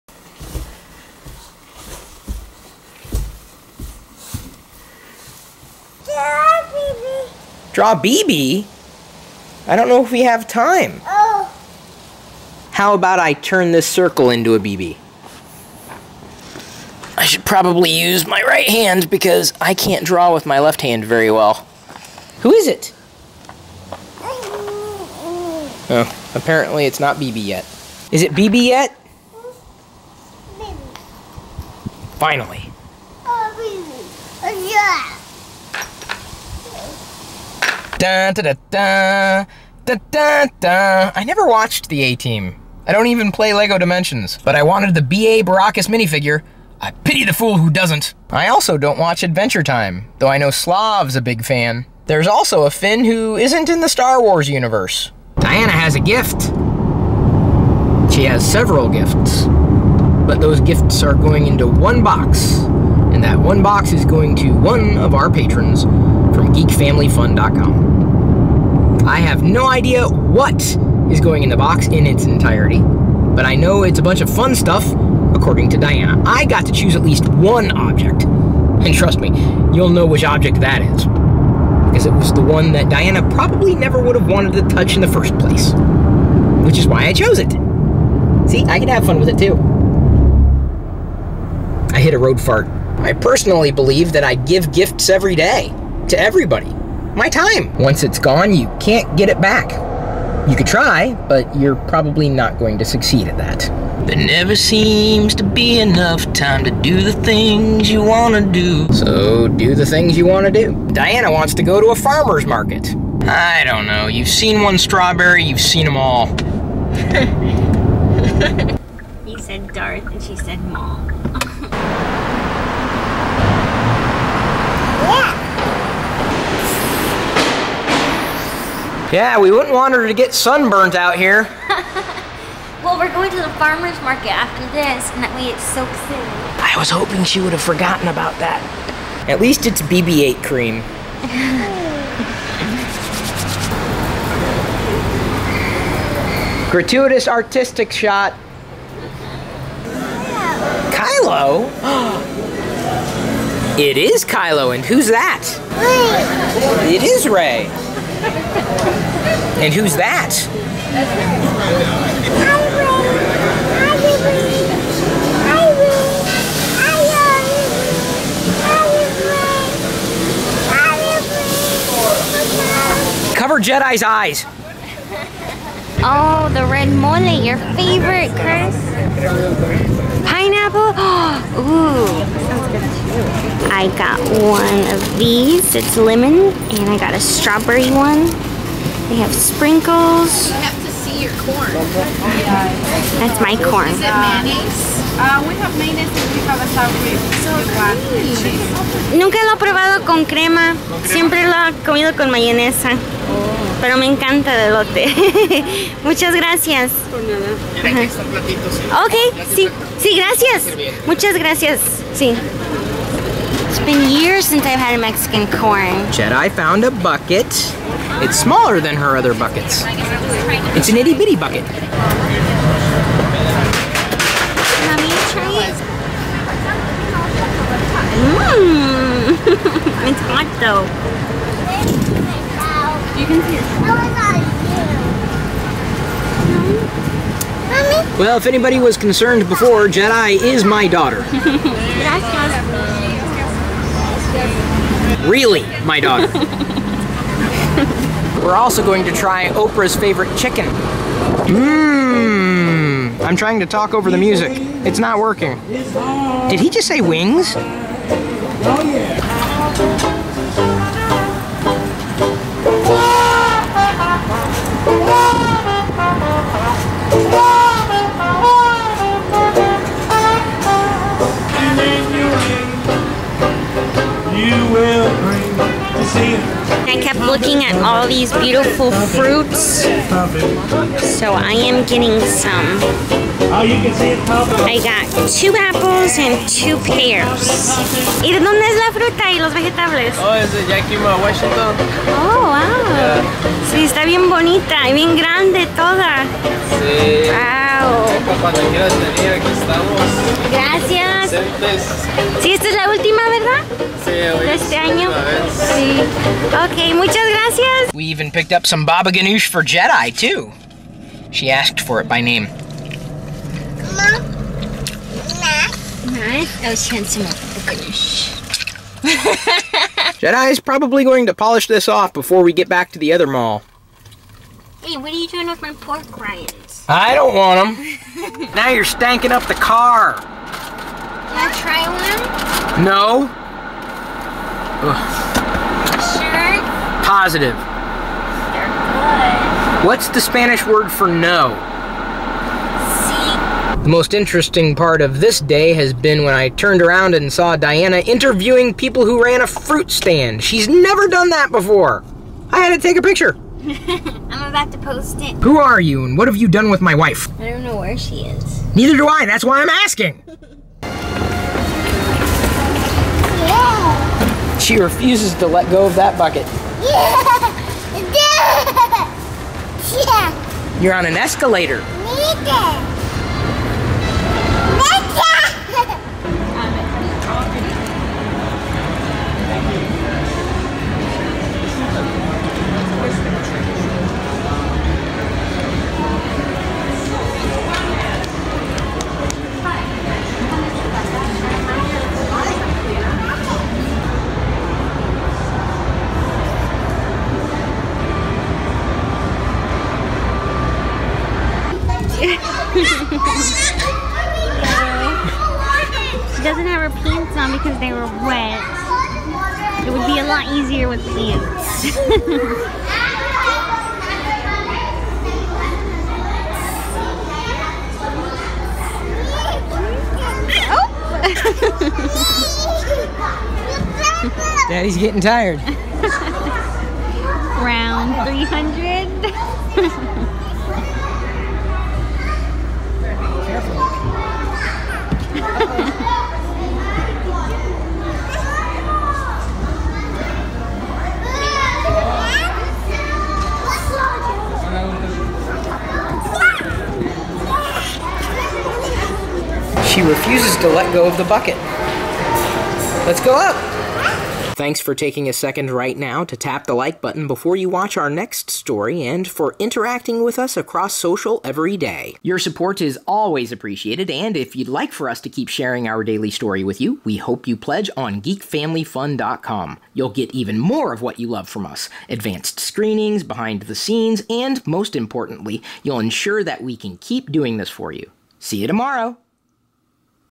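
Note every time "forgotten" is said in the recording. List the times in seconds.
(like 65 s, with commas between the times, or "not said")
137 s.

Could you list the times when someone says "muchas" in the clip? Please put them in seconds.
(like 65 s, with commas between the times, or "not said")
206 s, 211 s, 306 s.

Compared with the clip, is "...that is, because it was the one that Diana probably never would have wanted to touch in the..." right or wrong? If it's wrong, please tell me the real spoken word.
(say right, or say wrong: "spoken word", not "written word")
right.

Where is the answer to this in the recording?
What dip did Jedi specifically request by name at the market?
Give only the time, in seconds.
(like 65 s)
308 s.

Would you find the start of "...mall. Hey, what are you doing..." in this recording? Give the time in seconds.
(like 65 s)
323 s.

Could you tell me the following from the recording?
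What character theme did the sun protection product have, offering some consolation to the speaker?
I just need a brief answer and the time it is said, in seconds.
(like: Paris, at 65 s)
BB-8, at 139 s.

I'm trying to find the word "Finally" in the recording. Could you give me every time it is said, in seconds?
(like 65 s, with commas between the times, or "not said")
32 s.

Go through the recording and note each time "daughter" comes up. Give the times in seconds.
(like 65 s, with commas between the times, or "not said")
240 s, 245 s.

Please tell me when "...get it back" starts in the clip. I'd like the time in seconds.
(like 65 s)
99 s.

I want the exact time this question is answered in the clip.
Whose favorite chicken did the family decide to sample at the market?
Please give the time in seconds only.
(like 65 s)
249 s.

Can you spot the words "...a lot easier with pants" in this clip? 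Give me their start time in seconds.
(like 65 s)
410 s.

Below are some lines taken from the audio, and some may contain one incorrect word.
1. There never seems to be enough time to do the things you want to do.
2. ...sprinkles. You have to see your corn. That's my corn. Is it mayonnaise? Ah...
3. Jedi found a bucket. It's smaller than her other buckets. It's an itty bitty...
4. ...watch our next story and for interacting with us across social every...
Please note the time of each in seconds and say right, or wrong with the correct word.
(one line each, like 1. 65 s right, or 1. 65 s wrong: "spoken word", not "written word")
1. 104 s right
2. 189 s right
3. 216 s right
4. 457 s right.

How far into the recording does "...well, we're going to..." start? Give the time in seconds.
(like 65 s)
132 s.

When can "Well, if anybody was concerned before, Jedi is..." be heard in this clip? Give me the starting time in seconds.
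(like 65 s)
238 s.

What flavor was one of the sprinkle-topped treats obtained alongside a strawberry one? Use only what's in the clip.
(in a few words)
lemon.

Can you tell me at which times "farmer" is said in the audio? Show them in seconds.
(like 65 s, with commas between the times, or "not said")
111 s, 133 s.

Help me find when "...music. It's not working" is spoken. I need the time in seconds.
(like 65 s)
254 s.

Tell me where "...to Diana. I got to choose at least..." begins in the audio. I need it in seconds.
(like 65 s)
75 s.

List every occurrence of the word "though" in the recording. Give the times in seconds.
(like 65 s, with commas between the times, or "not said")
50 s, 230 s.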